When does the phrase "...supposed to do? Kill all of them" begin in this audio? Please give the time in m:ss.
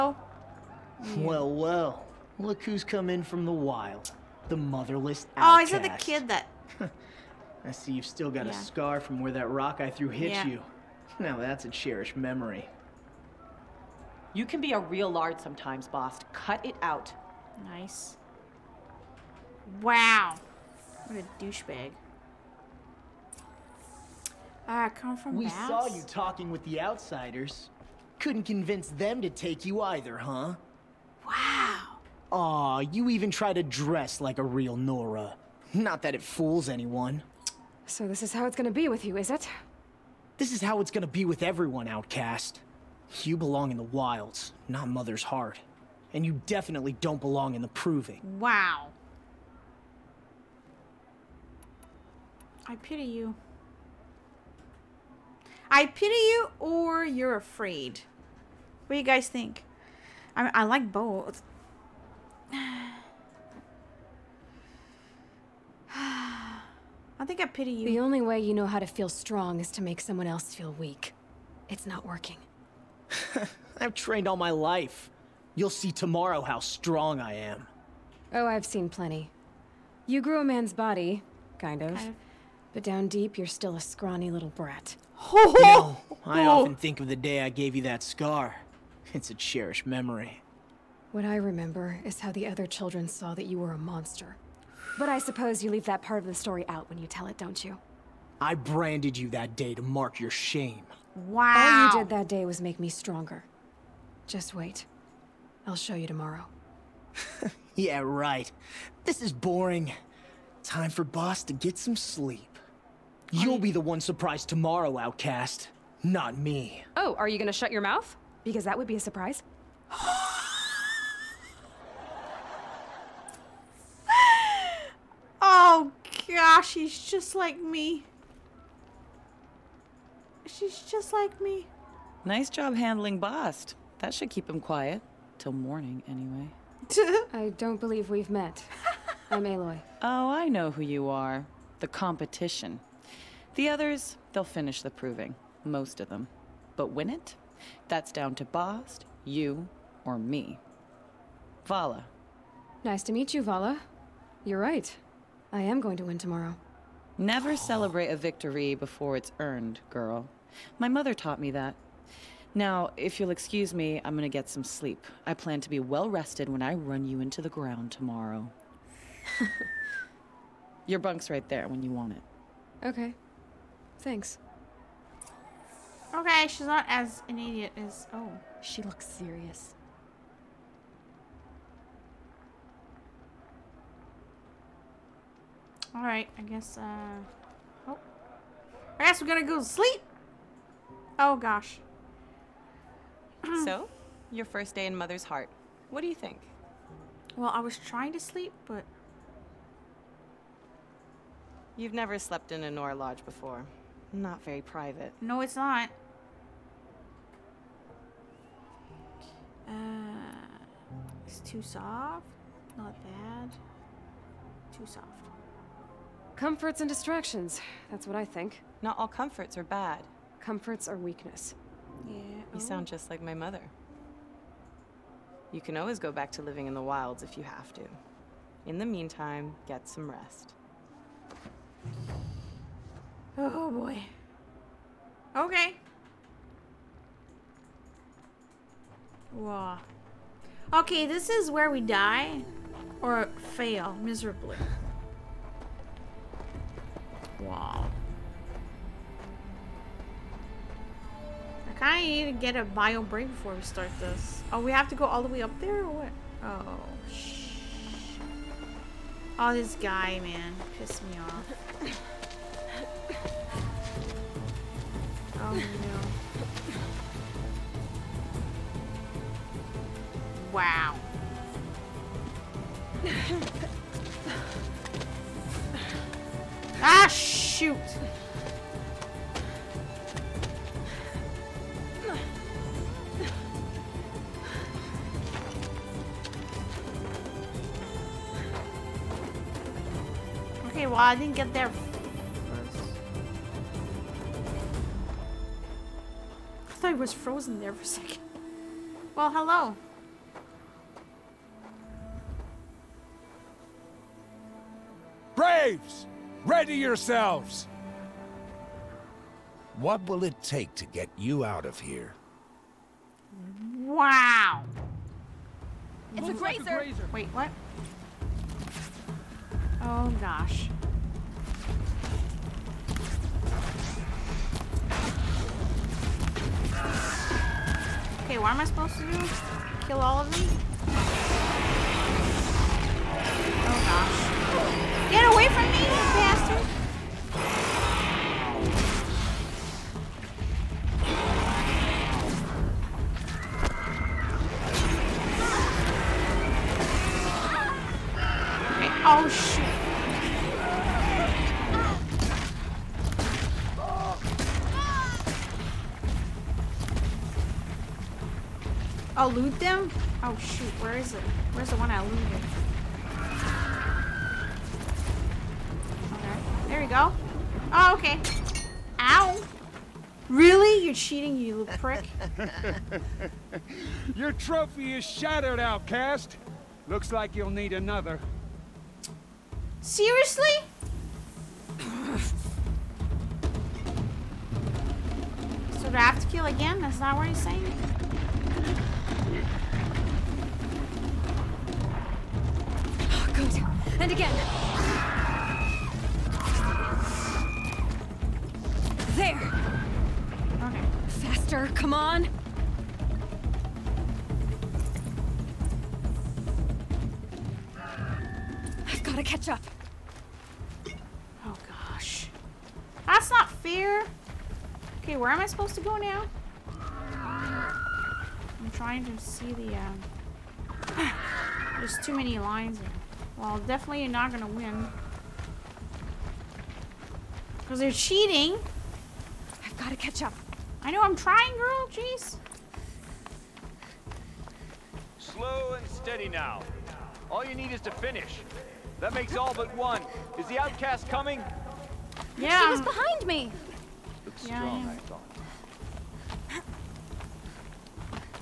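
5:28.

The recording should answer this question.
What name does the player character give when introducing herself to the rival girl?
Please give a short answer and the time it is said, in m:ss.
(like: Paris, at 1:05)
Aloy, at 2:19.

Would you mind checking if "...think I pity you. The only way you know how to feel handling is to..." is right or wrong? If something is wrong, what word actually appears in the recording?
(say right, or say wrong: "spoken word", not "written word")
wrong: "strong", not "handling".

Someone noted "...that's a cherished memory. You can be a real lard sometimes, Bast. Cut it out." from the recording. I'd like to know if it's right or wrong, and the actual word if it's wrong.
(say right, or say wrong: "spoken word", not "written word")
right.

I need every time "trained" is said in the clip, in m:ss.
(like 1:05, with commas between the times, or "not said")
1:13.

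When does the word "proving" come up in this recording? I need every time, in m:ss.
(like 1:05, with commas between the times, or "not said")
0:47, 2:24.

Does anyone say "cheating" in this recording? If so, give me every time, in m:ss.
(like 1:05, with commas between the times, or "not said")
6:10, 7:07.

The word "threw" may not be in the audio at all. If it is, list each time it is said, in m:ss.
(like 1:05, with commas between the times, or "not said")
0:09.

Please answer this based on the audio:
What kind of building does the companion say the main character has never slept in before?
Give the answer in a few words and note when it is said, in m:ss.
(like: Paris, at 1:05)
A Nora Lodge, at 3:22.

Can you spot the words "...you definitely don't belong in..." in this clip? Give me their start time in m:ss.
0:46.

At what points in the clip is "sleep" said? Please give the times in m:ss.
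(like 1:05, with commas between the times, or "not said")
1:51, 2:44, 3:09, 3:18.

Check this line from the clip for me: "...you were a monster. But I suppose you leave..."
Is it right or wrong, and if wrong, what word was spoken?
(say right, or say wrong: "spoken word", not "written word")
right.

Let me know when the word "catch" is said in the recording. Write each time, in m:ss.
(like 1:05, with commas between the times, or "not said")
6:49, 7:09.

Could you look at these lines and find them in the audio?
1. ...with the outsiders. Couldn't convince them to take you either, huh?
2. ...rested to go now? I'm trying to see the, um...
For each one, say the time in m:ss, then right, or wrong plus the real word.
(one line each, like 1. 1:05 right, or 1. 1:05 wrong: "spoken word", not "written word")
1. 0:26 right
2. 6:55 wrong: "supposed", not "rested".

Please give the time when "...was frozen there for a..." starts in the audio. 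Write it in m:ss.
4:56.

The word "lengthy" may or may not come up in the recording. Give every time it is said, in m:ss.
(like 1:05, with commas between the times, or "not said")
not said.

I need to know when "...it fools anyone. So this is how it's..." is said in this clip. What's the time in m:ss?
0:36.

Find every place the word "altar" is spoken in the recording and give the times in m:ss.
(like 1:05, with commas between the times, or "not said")
not said.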